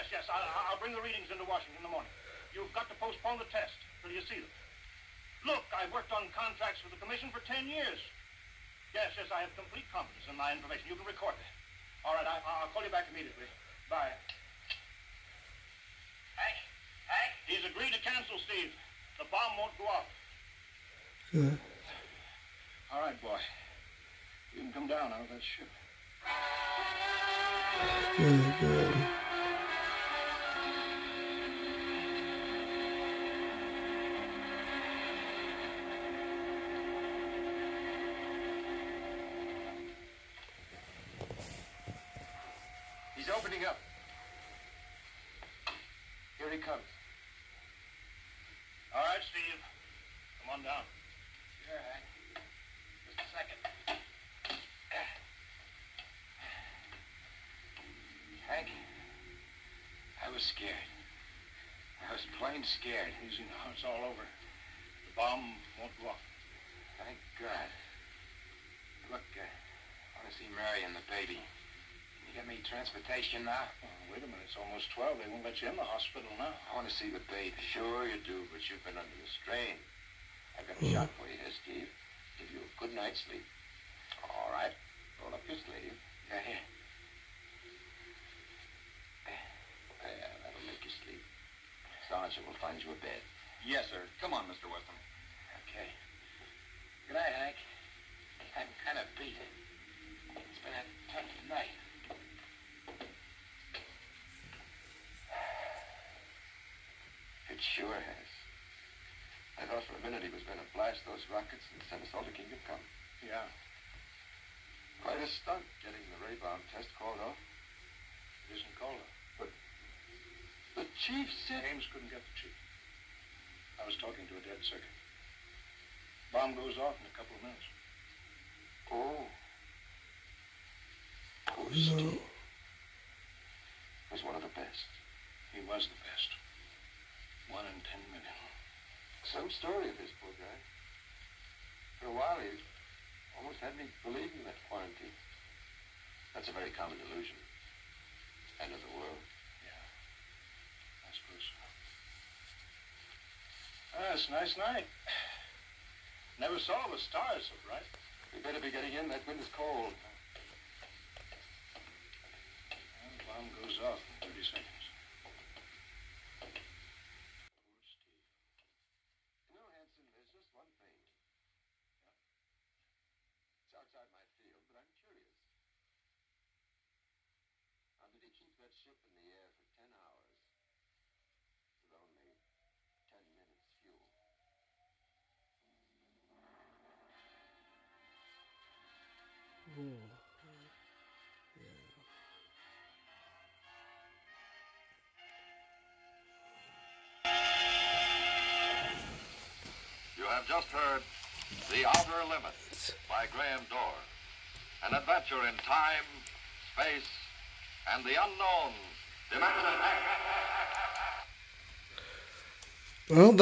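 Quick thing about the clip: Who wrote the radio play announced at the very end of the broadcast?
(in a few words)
Graham Doar.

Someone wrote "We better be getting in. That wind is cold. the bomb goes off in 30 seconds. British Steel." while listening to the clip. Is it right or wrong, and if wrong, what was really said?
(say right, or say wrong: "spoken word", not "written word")
right.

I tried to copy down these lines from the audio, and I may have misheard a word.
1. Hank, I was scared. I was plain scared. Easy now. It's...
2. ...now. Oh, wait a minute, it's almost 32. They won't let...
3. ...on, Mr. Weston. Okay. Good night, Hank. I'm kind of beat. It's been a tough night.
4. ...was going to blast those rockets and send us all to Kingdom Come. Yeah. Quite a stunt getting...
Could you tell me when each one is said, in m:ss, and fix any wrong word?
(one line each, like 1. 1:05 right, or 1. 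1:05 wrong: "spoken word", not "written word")
1. 0:58 right
2. 1:13 wrong: "12", not "32"
3. 1:34 right
4. 1:50 right.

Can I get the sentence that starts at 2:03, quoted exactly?
I was talking to a dead circuit.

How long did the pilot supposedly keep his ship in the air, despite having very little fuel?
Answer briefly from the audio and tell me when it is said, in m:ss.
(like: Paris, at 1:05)
10 hours, at 2:59.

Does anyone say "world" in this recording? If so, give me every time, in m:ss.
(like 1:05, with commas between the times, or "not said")
2:28.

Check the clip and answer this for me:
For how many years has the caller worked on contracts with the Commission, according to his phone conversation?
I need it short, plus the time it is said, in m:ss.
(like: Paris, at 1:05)
10, at 0:07.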